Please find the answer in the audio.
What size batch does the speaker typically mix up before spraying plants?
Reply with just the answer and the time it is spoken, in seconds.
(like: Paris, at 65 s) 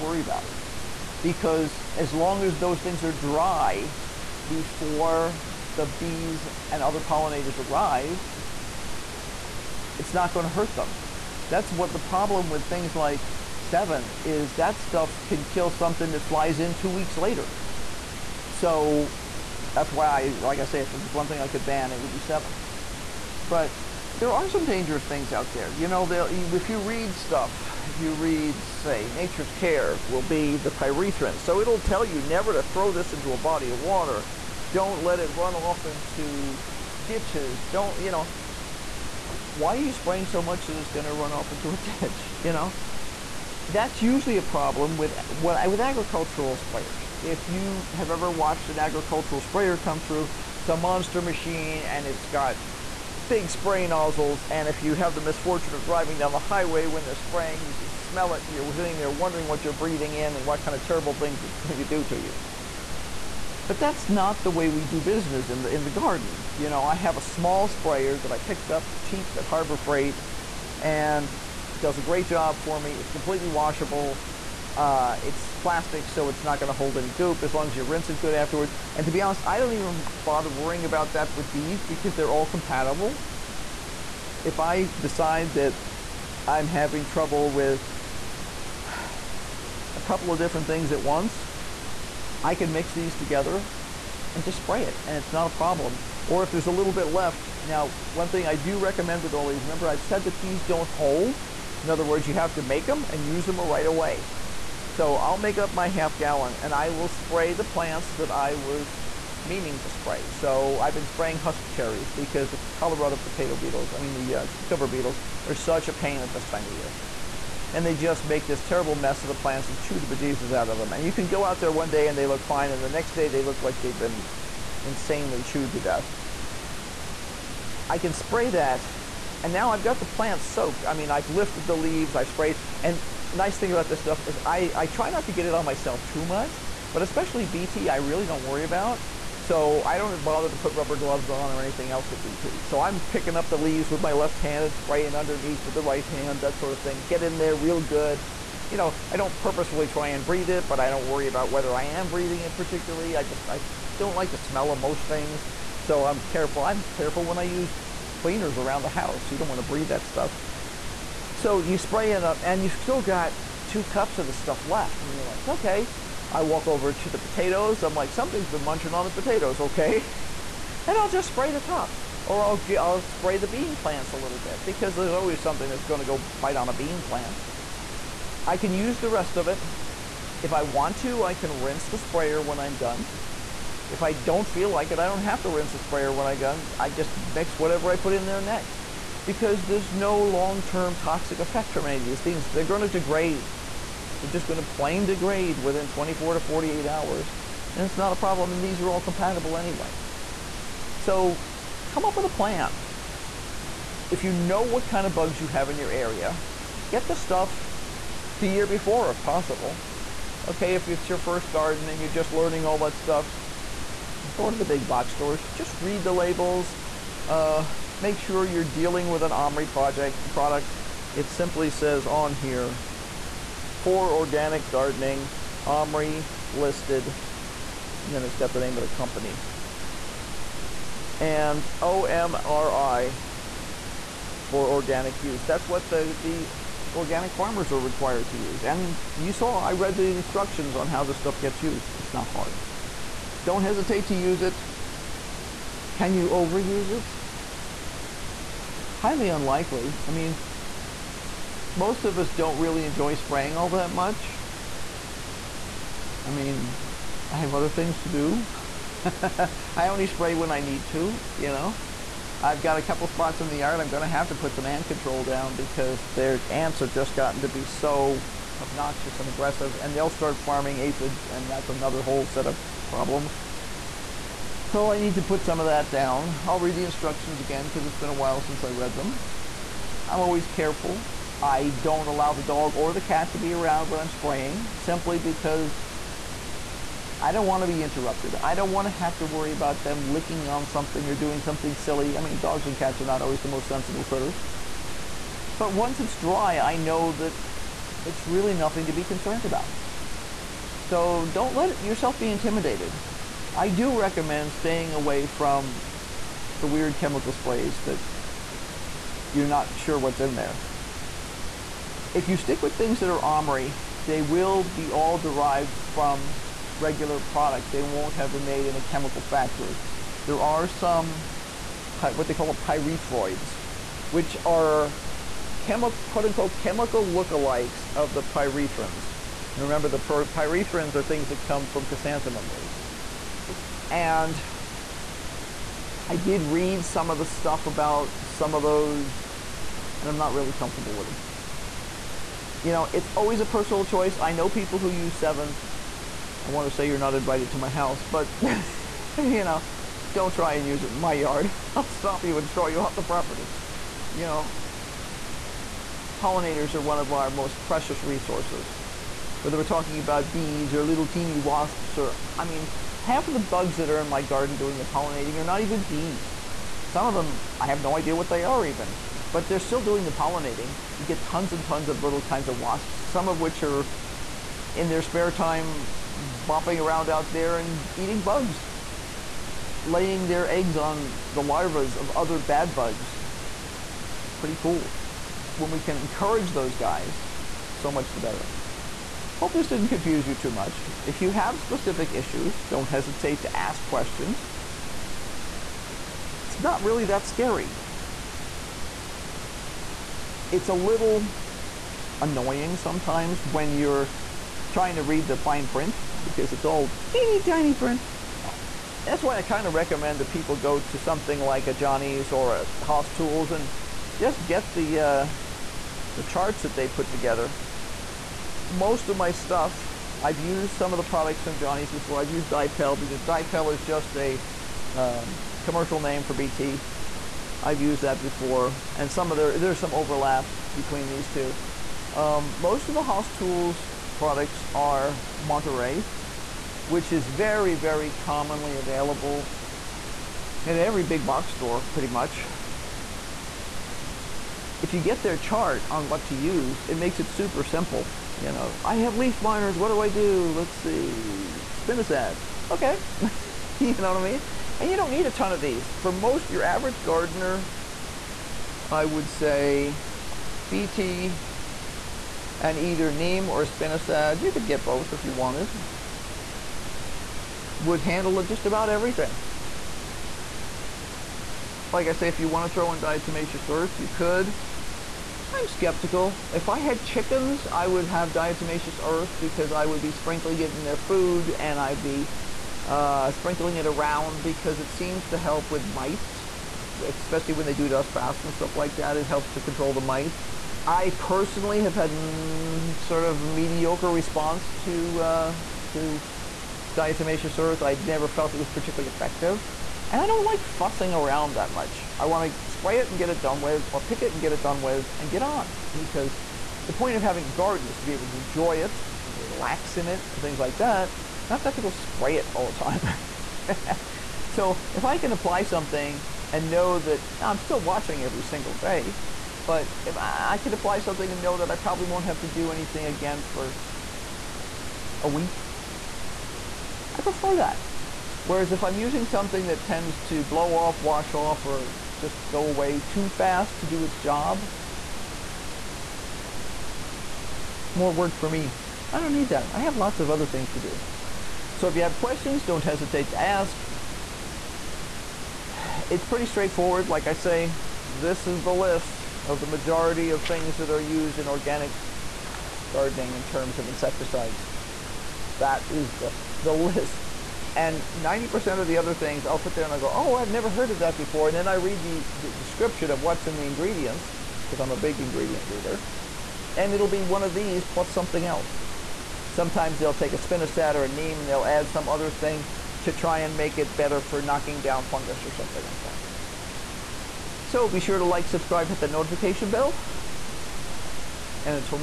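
Half gallon, at 105 s.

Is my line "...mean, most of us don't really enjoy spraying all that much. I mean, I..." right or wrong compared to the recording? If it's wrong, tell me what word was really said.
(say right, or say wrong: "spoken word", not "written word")
right.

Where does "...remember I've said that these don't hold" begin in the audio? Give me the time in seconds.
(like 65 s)
99 s.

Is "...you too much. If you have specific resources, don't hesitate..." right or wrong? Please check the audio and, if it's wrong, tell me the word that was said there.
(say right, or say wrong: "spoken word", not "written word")
wrong: "issues", not "resources".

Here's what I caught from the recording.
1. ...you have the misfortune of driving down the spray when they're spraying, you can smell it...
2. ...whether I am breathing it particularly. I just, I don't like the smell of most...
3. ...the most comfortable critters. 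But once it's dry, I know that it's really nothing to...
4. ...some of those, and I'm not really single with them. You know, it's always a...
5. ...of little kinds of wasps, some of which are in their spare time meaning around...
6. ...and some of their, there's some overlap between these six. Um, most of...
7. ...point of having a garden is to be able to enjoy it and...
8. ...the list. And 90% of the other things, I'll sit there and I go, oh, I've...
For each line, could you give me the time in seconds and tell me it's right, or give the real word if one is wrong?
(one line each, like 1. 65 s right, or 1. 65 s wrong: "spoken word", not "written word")
1. 54 s wrong: "highway", not "spray"
2. 151 s right
3. 293 s wrong: "sensible", not "comfortable"
4. 338 s wrong: "comfortable", not "single"
5. 371 s wrong: "bumping", not "meaning"
6. 428 s wrong: "two", not "six"
7. 506 s right
8. 556 s right.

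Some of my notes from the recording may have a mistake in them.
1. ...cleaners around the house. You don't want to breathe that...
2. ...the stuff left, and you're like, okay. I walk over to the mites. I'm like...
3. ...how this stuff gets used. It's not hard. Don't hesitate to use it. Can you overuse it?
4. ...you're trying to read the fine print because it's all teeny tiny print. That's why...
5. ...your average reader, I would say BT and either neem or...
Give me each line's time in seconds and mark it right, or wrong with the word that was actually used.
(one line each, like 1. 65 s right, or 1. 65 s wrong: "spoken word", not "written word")
1. 158 s right
2. 164 s wrong: "potatoes", not "mites"
3. 240 s right
4. 403 s right
5. 456 s wrong: "gardener", not "reader".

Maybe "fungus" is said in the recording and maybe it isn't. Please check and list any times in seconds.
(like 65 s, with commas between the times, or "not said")
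575 s.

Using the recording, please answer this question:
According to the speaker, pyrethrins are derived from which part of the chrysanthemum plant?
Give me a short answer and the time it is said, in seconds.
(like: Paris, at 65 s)
Roots, at 331 s.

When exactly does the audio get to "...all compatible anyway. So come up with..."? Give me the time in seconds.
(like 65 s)
198 s.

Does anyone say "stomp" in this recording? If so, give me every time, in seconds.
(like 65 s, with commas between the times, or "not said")
351 s.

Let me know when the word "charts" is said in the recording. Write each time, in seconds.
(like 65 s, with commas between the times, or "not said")
416 s, 445 s.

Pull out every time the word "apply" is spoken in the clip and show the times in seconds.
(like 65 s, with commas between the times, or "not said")
515 s, 520 s.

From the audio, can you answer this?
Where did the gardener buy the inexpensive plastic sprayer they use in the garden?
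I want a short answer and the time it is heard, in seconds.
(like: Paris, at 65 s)
Harbor Freight, at 69 s.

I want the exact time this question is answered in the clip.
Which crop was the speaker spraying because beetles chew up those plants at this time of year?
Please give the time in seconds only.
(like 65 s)
111 s.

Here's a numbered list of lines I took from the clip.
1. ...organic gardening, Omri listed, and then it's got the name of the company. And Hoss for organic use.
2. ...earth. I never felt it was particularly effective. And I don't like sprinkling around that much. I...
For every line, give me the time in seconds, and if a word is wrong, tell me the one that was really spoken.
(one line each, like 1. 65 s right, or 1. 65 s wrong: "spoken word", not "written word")
1. 224 s wrong: "OMRI", not "Hoss"
2. 497 s wrong: "fussing", not "sprinkling".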